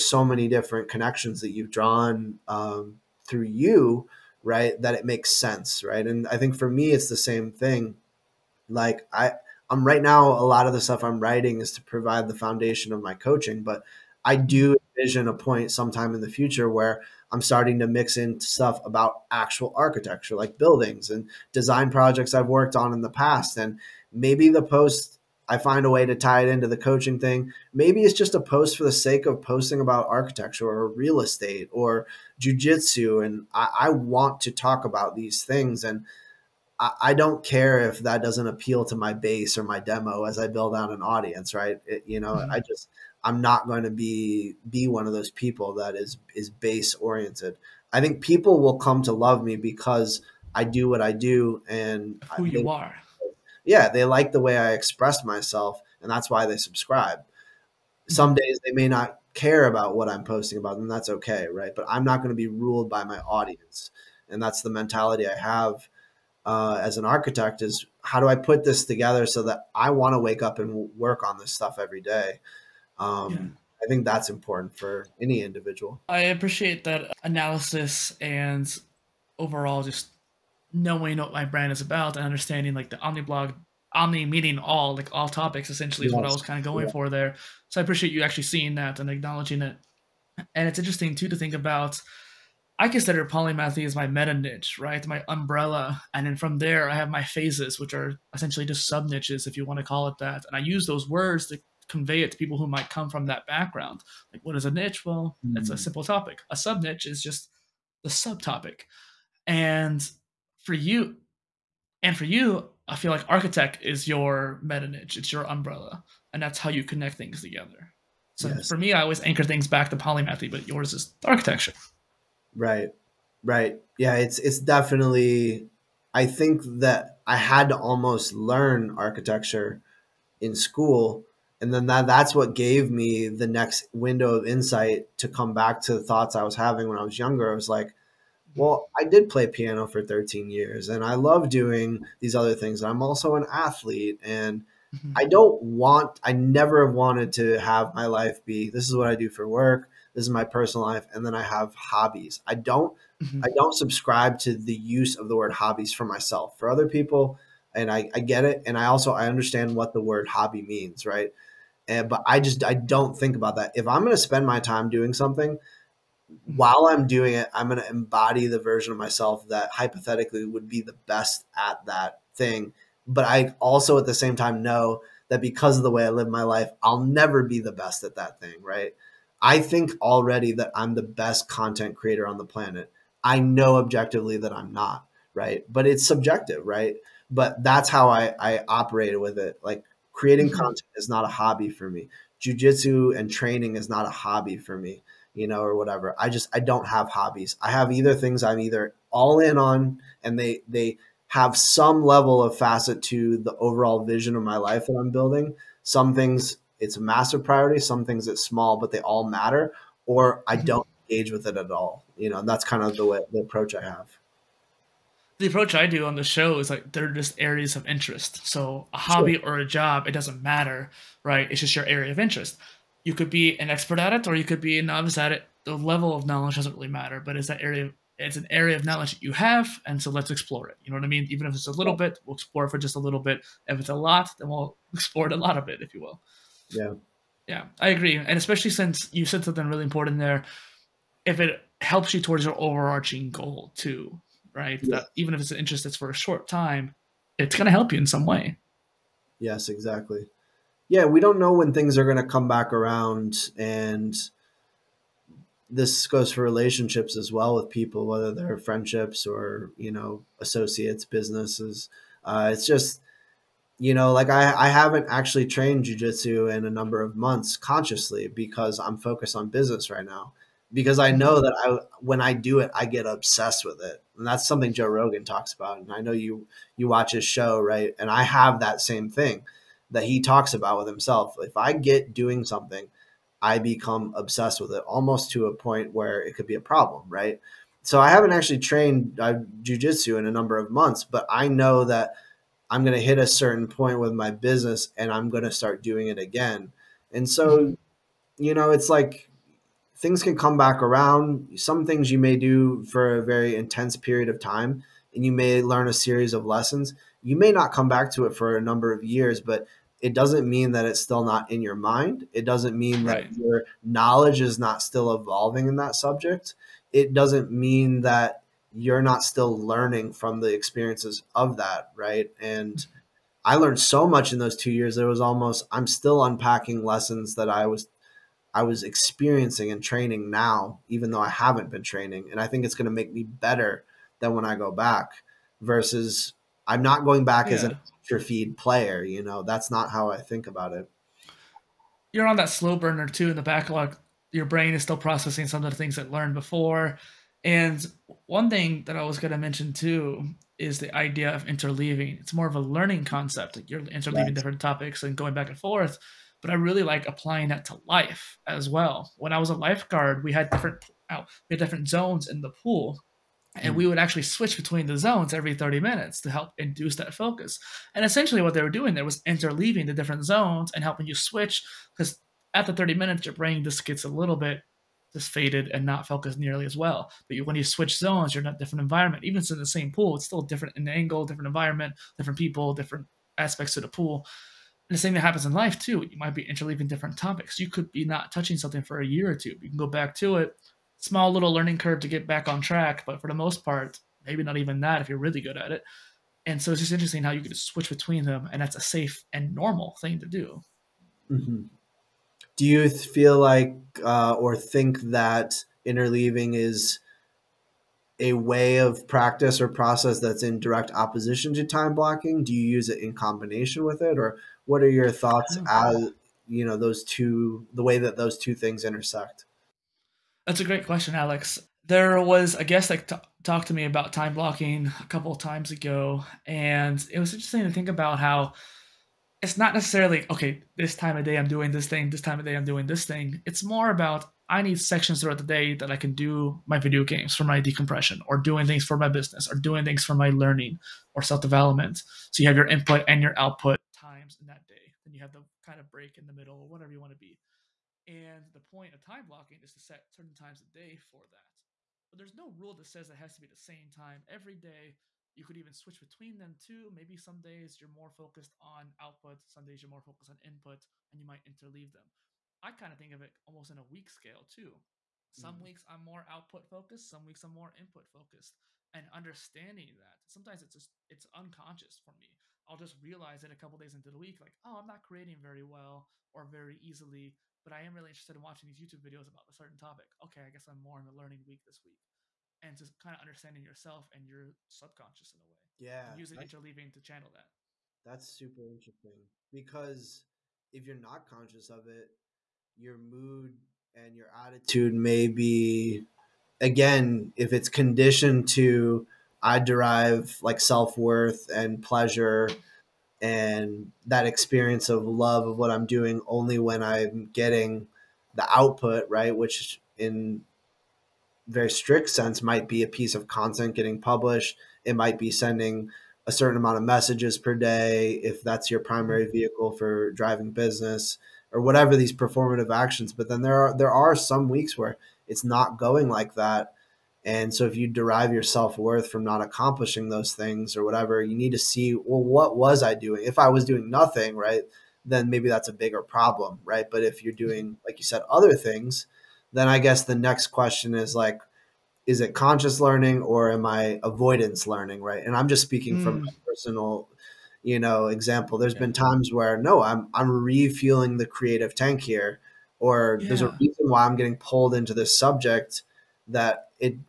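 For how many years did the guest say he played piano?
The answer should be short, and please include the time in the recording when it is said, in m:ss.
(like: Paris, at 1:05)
13, at 2:20.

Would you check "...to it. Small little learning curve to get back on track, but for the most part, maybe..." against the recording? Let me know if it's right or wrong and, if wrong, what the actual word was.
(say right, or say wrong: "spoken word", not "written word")
right.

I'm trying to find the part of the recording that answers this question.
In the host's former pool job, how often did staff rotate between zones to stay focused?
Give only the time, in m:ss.
6:05.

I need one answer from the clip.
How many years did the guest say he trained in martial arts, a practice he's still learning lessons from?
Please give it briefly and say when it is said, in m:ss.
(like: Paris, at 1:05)
2, at 5:24.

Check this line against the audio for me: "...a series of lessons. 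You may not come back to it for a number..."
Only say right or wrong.
right.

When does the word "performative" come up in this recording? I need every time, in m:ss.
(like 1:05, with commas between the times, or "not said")
8:42.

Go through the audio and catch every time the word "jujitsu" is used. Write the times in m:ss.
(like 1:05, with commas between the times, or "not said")
0:32, 3:12, 4:25, 4:49.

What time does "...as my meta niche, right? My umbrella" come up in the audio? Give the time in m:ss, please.
1:33.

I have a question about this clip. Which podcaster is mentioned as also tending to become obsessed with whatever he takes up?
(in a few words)
Joe Rogan.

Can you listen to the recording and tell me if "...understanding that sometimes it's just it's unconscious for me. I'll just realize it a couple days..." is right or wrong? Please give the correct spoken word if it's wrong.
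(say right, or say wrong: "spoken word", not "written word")
right.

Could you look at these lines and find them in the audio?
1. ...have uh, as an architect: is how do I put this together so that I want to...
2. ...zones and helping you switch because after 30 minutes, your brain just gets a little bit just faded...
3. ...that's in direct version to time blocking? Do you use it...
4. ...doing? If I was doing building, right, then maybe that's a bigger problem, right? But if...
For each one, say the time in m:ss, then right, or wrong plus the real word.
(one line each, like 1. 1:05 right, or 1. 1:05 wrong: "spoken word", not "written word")
1. 1:05 right
2. 6:10 right
3. 6:50 wrong: "opposition", not "version"
4. 8:52 wrong: "nothing", not "building".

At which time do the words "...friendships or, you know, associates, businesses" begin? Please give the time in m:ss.
4:18.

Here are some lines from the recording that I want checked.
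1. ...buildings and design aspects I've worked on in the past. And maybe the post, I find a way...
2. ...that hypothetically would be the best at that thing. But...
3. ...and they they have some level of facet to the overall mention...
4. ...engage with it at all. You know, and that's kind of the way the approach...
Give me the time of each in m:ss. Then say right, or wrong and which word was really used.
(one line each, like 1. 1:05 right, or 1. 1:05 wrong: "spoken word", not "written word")
1. 0:20 wrong: "projects", not "aspects"
2. 2:49 right
3. 3:20 wrong: "vision", not "mention"
4. 3:31 right.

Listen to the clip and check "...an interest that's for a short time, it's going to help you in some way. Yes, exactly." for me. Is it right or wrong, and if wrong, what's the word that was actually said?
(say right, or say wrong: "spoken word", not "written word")
right.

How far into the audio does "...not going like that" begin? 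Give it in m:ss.
8:45.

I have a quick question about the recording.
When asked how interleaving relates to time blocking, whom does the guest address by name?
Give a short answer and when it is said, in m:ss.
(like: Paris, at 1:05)
Alex, at 7:01.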